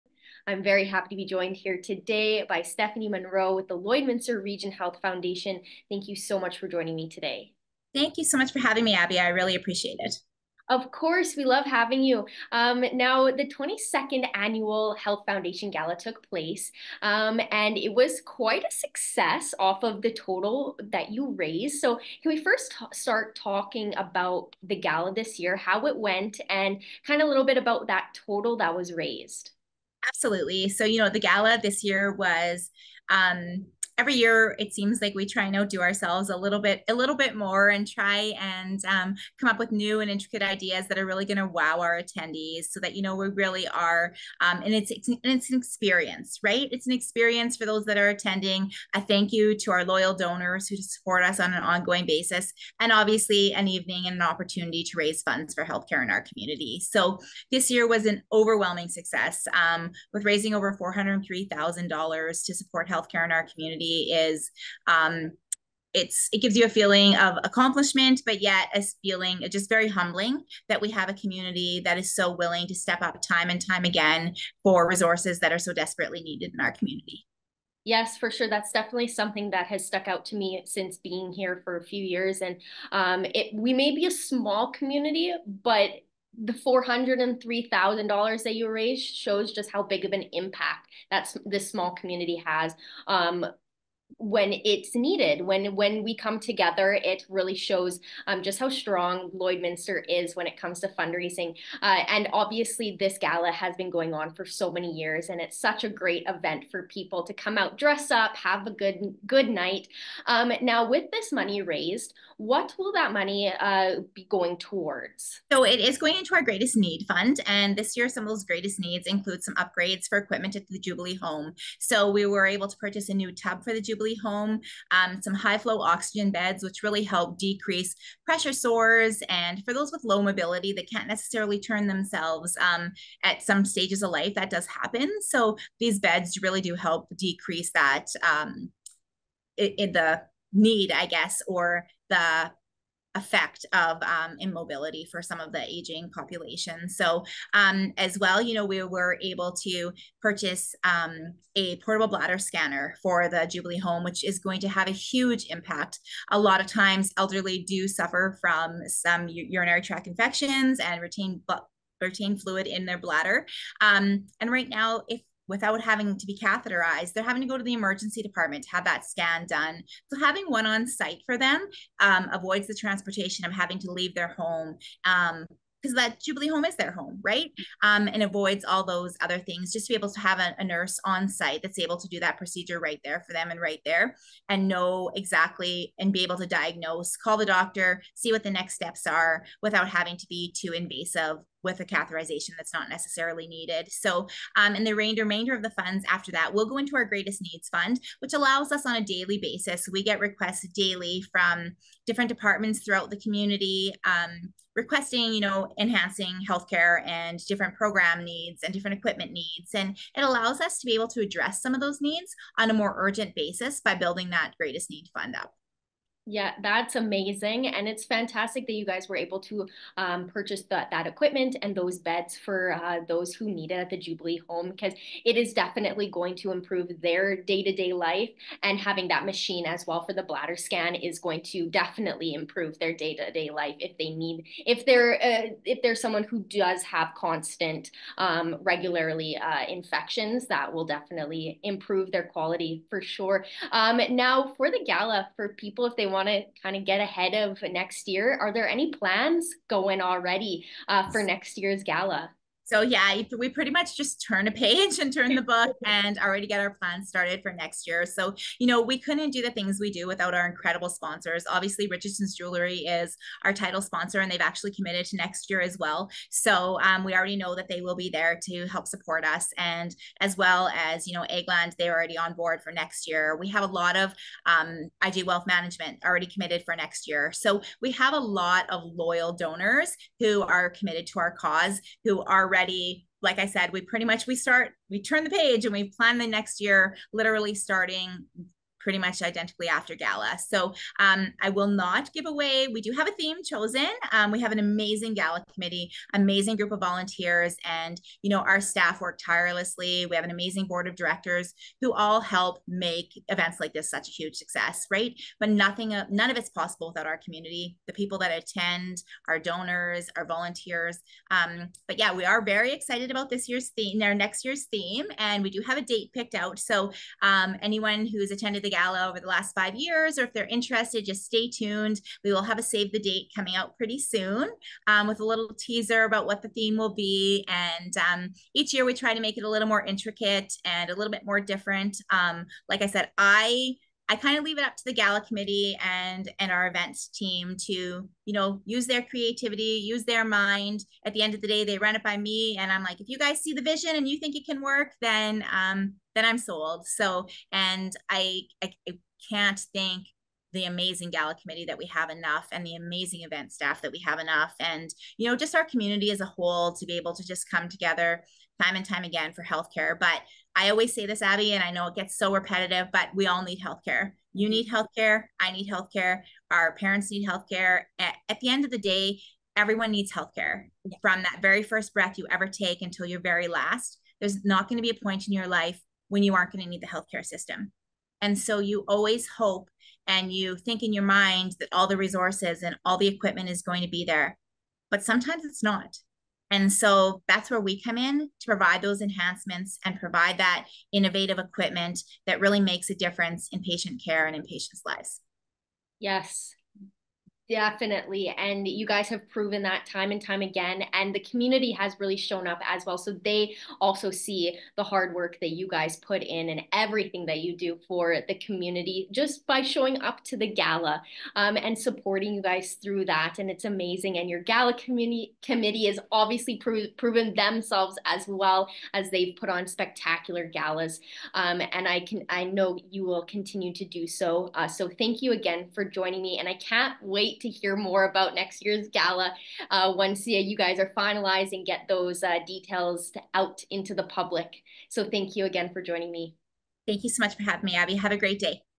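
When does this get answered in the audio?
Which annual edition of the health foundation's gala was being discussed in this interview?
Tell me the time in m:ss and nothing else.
0:13.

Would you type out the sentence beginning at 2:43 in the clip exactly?
Um, and right now, if without having to be catheterized.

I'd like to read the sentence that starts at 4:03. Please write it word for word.
Um, now, for the gala, for people, if they want, want to kind of get ahead of next year.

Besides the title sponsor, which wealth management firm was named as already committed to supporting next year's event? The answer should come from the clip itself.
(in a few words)
IG Wealth Management.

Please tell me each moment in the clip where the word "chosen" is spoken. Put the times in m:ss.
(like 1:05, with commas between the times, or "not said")
4:53.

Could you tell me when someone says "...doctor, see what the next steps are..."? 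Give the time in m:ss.
3:07.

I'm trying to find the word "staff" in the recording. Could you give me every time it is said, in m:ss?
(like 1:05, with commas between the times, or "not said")
4:58, 5:53.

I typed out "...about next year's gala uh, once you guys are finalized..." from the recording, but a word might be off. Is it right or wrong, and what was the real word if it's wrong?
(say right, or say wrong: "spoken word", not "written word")
right.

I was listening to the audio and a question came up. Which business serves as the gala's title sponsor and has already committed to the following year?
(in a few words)
Richardson's Jewelry.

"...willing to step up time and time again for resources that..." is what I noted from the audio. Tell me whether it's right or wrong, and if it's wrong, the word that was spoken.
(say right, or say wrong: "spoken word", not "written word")
right.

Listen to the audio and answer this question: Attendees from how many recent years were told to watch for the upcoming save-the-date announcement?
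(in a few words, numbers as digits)
5 years.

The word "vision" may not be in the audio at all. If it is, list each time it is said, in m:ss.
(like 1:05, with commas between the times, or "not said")
5:43.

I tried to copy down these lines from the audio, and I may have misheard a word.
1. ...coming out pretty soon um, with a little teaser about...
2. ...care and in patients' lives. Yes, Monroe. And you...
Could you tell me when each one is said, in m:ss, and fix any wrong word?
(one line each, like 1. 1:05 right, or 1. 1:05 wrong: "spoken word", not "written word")
1. 5:23 right
2. 6:34 wrong: "Definitely", not "Monroe".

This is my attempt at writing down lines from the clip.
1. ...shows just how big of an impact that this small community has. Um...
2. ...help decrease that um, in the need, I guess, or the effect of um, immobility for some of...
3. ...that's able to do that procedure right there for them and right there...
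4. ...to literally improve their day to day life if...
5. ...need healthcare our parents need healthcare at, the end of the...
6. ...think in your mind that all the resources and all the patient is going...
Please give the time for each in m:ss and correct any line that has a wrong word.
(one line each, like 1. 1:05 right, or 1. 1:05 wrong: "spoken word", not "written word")
1. 1:29 right
2. 2:16 right
3. 3:01 right
4. 3:51 wrong: "definitely", not "literally"
5. 6:05 right
6. 6:20 wrong: "equipment", not "patient".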